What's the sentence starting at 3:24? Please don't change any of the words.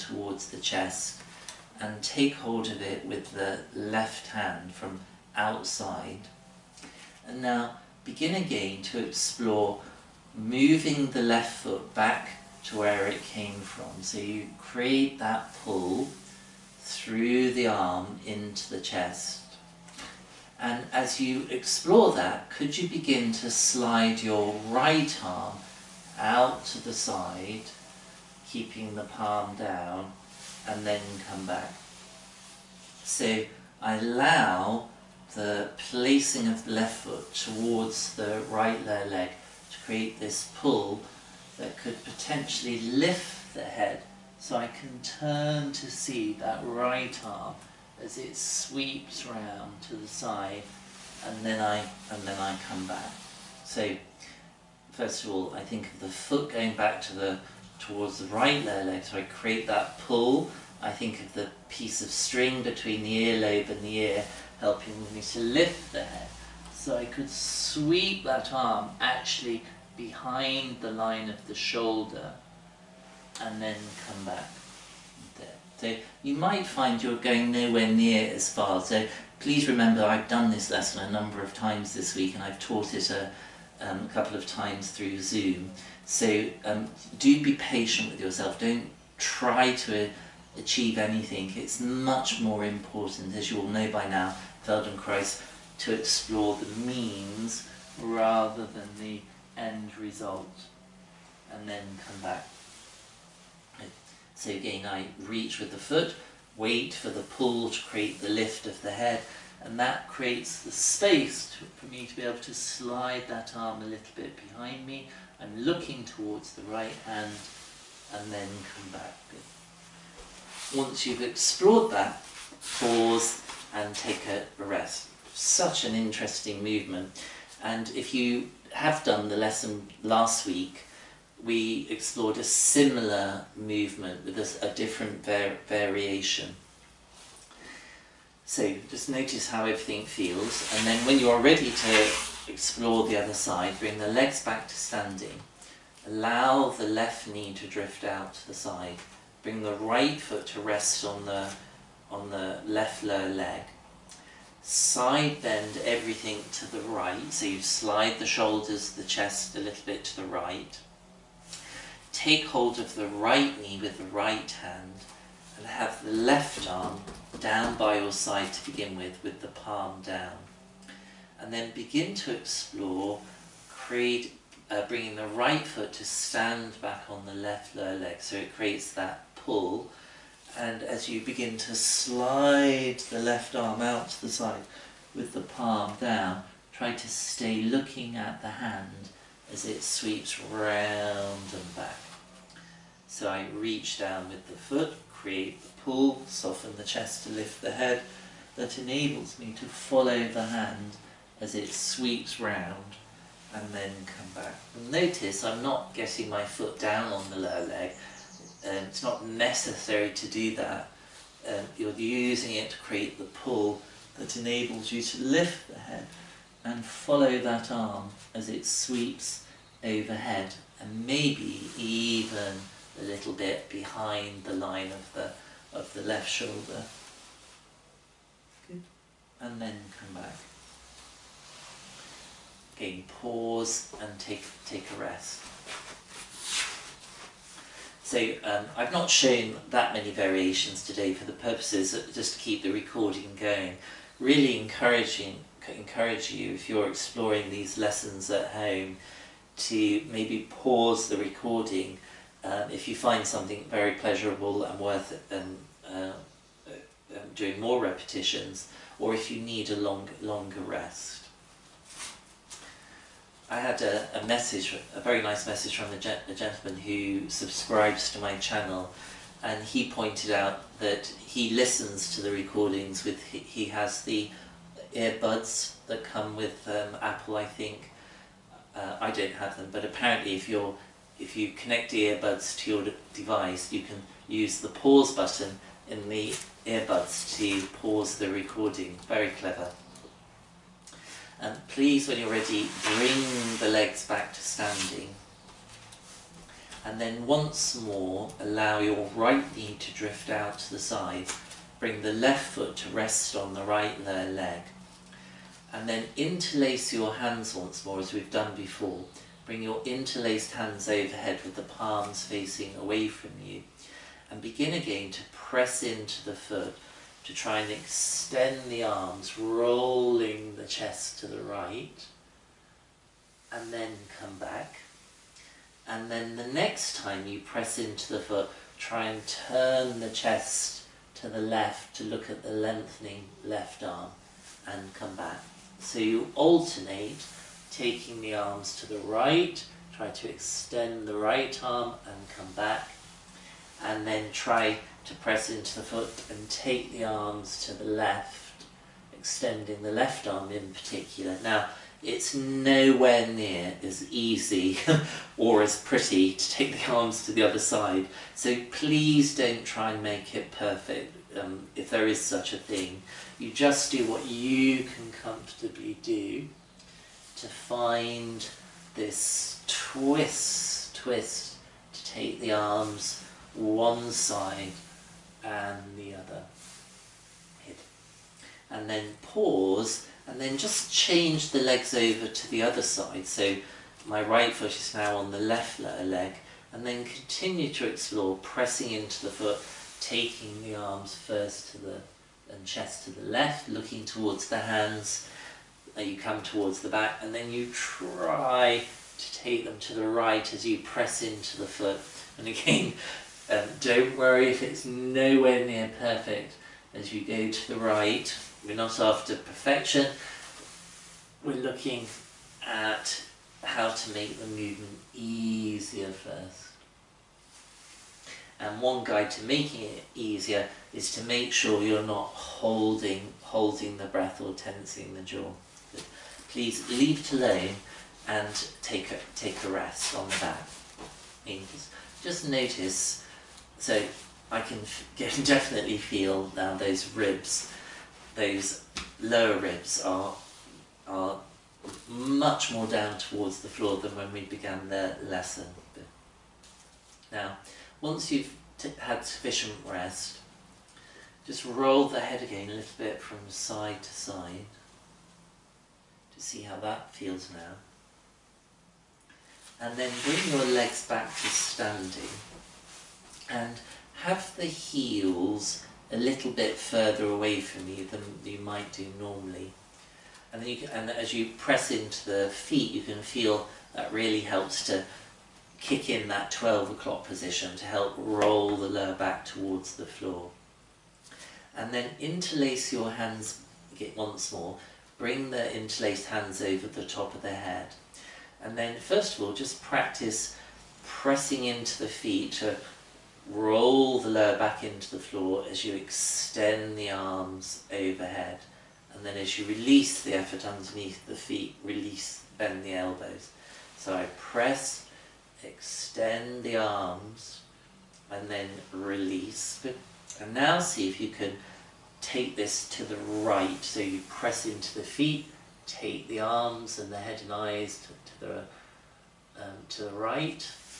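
Notice I'm not getting my foot down on the lower leg.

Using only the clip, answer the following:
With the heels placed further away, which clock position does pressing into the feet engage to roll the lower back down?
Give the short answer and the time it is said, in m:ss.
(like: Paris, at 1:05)
12 o'clock, at 7:56.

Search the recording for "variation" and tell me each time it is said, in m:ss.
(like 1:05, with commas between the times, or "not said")
2:15, 4:00.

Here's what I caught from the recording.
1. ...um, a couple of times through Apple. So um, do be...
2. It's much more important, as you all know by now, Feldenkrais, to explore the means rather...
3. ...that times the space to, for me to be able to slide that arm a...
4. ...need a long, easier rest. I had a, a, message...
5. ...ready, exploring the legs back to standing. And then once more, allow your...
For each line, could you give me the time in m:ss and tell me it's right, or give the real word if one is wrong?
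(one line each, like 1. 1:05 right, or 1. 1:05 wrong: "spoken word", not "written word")
1. 1:23 wrong: "Zoom", not "Apple"
2. 1:31 right
3. 1:49 wrong: "creates", not "times"
4. 4:19 wrong: "longer", not "easier"
5. 4:52 wrong: "bring", not "exploring".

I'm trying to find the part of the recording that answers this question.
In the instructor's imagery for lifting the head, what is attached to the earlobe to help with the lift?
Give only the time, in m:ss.
1:01.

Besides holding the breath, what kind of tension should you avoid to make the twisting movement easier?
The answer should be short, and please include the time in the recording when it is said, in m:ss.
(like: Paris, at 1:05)
tensing the jaw, at 7:04.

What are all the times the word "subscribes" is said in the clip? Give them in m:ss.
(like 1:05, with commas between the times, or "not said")
4:27.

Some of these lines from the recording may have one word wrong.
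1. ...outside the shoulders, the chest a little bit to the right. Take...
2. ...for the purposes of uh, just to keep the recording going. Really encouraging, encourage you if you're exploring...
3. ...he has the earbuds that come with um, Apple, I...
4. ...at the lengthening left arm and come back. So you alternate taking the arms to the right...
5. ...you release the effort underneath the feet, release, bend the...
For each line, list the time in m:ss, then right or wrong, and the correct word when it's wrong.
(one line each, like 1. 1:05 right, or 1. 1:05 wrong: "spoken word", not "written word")
1. 2:37 wrong: "slide", not "outside"
2. 4:01 right
3. 4:33 right
4. 5:32 right
5. 8:19 right.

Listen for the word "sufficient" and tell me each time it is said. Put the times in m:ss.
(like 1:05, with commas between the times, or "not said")
7:29.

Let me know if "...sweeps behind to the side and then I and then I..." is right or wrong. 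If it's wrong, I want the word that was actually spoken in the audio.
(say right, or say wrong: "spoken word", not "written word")
wrong: "round", not "behind".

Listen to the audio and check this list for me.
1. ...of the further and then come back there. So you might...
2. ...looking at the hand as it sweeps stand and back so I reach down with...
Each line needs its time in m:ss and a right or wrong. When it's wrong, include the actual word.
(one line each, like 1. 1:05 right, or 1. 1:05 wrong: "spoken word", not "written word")
1. 1:11 wrong: "shoulder", not "further"
2. 3:07 wrong: "round", not "stand".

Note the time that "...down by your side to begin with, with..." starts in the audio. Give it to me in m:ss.
2:47.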